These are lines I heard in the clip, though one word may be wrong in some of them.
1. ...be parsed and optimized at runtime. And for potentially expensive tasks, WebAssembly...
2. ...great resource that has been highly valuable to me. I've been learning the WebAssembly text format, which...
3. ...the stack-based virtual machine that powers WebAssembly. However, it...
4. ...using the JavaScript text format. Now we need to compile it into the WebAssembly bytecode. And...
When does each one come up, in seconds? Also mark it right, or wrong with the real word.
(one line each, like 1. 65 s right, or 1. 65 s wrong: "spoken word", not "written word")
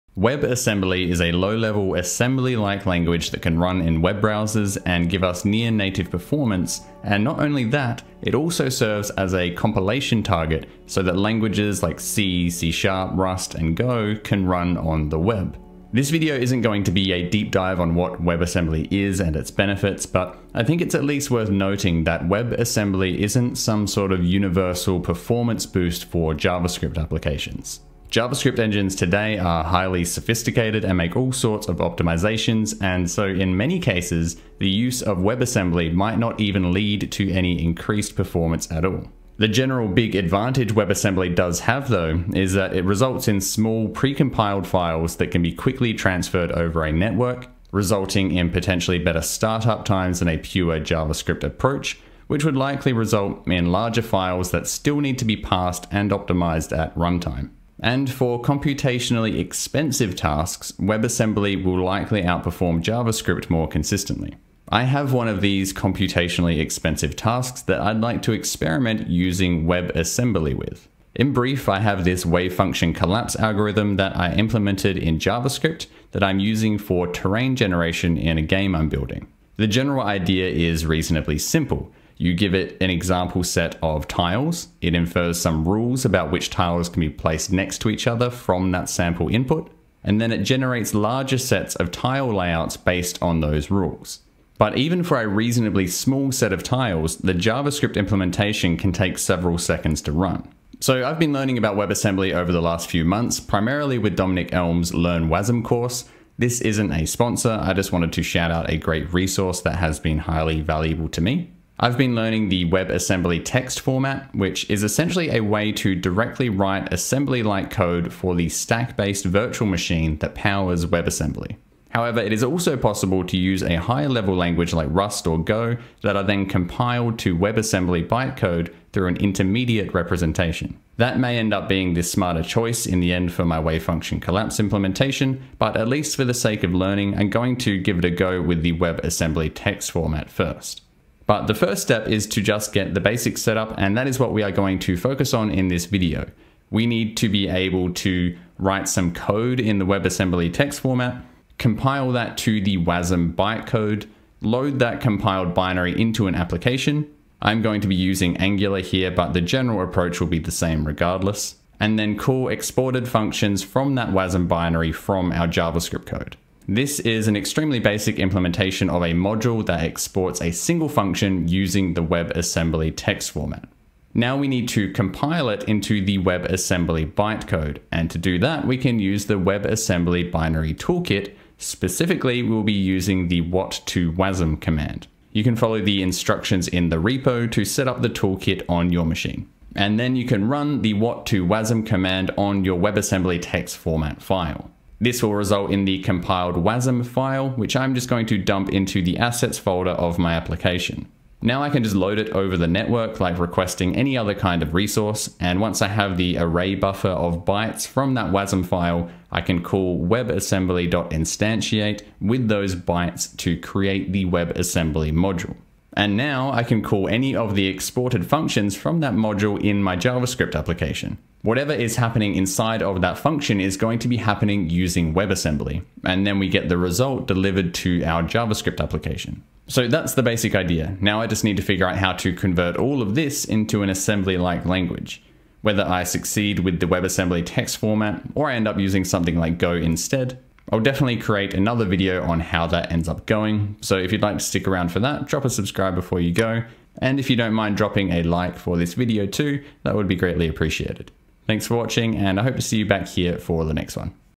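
1. 55 s wrong: "computationally", not "potentially"
2. 108 s right
3. 118 s right
4. 171 s wrong: "WebAssembly", not "JavaScript".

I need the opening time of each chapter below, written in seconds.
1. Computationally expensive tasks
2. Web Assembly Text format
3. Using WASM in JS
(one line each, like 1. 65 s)
1. 64 s
2. 100 s
3. 141 s.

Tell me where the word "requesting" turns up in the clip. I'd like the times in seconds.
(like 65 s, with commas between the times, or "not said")
203 s.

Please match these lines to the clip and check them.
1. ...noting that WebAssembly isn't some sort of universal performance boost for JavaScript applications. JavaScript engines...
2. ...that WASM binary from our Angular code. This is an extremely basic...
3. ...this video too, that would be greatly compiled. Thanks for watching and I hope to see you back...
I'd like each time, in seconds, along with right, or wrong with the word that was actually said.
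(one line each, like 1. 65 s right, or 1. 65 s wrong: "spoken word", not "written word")
1. 21 s right
2. 163 s wrong: "JavaScript", not "Angular"
3. 248 s wrong: "appreciated", not "compiled".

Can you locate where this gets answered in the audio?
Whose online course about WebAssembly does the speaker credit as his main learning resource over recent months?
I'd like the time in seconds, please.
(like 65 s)
104 s.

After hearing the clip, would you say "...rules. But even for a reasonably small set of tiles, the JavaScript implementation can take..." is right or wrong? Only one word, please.
right.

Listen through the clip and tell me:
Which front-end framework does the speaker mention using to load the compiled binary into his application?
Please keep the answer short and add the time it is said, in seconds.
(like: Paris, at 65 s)
Angular, at 158 s.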